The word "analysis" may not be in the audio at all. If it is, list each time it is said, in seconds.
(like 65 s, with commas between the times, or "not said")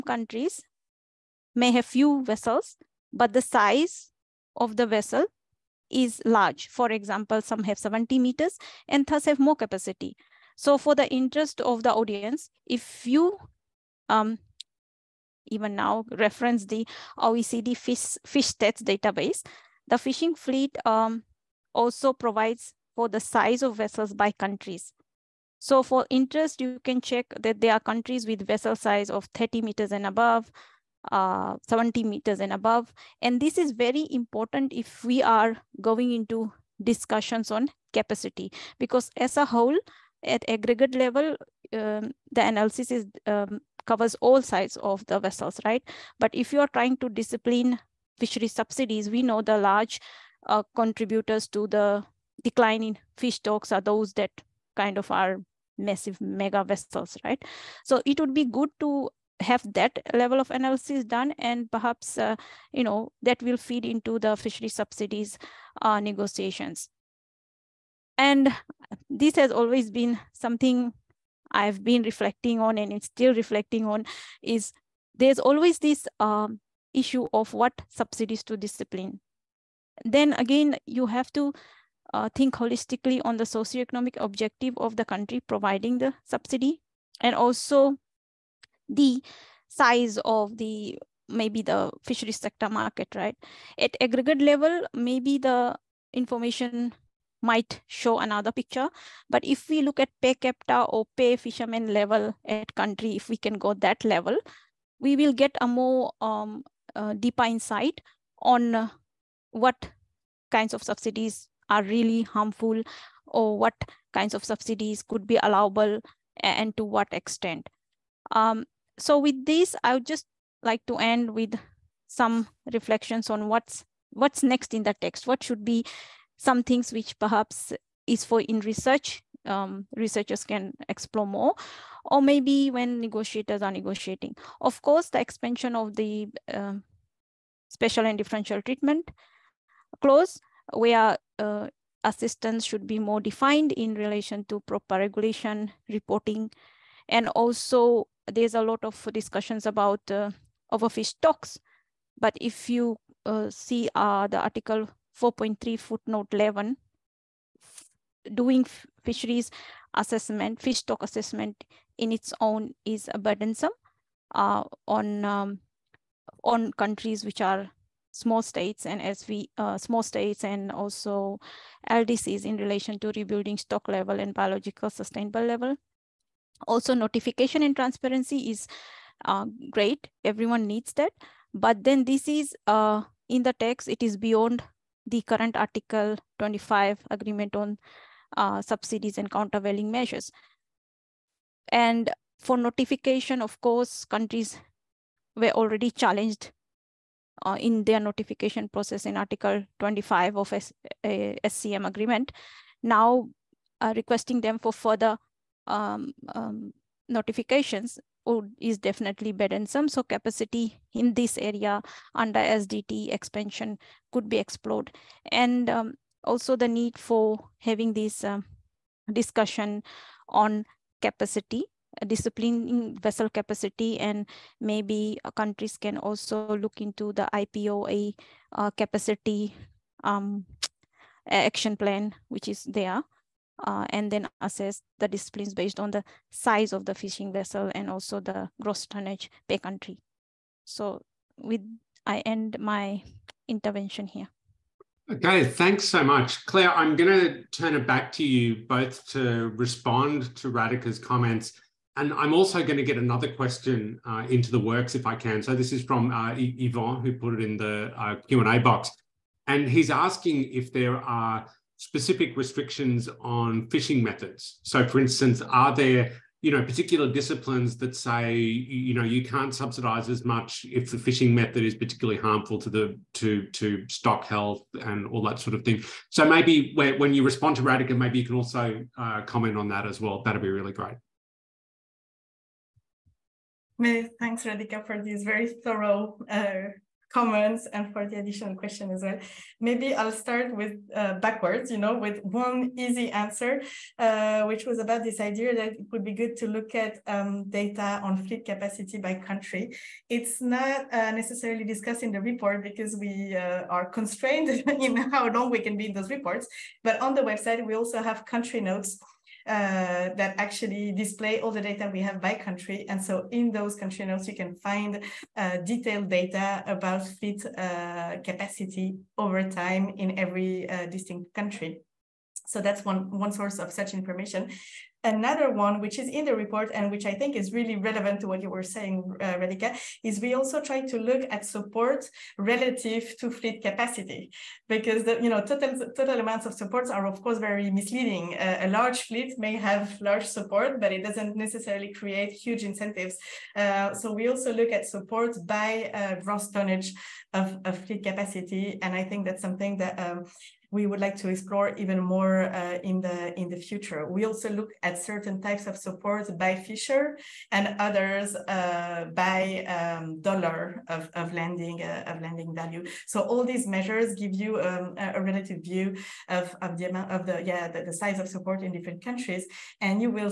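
42 s, 60 s.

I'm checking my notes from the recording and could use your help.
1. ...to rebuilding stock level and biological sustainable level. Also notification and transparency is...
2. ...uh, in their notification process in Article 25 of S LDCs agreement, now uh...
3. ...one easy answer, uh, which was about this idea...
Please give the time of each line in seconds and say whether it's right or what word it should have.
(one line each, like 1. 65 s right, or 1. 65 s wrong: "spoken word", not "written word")
1. 173 s right
2. 197 s wrong: "SCM", not "LDCs"
3. 292 s right.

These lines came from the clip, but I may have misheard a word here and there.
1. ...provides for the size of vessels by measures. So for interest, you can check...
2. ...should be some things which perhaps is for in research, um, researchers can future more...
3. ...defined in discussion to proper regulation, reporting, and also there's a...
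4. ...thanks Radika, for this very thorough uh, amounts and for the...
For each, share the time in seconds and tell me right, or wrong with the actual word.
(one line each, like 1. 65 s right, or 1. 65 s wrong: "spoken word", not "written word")
1. 22 s wrong: "countries", not "measures"
2. 125 s wrong: "explore", not "future"
3. 143 s wrong: "relation", not "discussion"
4. 284 s wrong: "comments", not "amounts".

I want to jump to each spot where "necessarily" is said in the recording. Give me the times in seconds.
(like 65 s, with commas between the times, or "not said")
301 s, 341 s.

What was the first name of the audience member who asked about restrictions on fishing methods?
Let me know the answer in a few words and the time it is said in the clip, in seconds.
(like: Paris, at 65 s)
Yvon, at 256 s.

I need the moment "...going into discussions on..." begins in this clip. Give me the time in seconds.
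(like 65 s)
35 s.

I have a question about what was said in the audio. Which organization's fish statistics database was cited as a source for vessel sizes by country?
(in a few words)
OECD.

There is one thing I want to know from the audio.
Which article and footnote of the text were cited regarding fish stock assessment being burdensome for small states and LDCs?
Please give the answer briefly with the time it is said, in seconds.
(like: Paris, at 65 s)
Article 4.3 footnote 11, at 154 s.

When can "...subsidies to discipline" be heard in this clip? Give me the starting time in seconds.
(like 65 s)
77 s.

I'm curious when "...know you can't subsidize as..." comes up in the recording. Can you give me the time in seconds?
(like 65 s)
268 s.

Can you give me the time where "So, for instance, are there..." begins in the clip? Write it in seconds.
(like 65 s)
264 s.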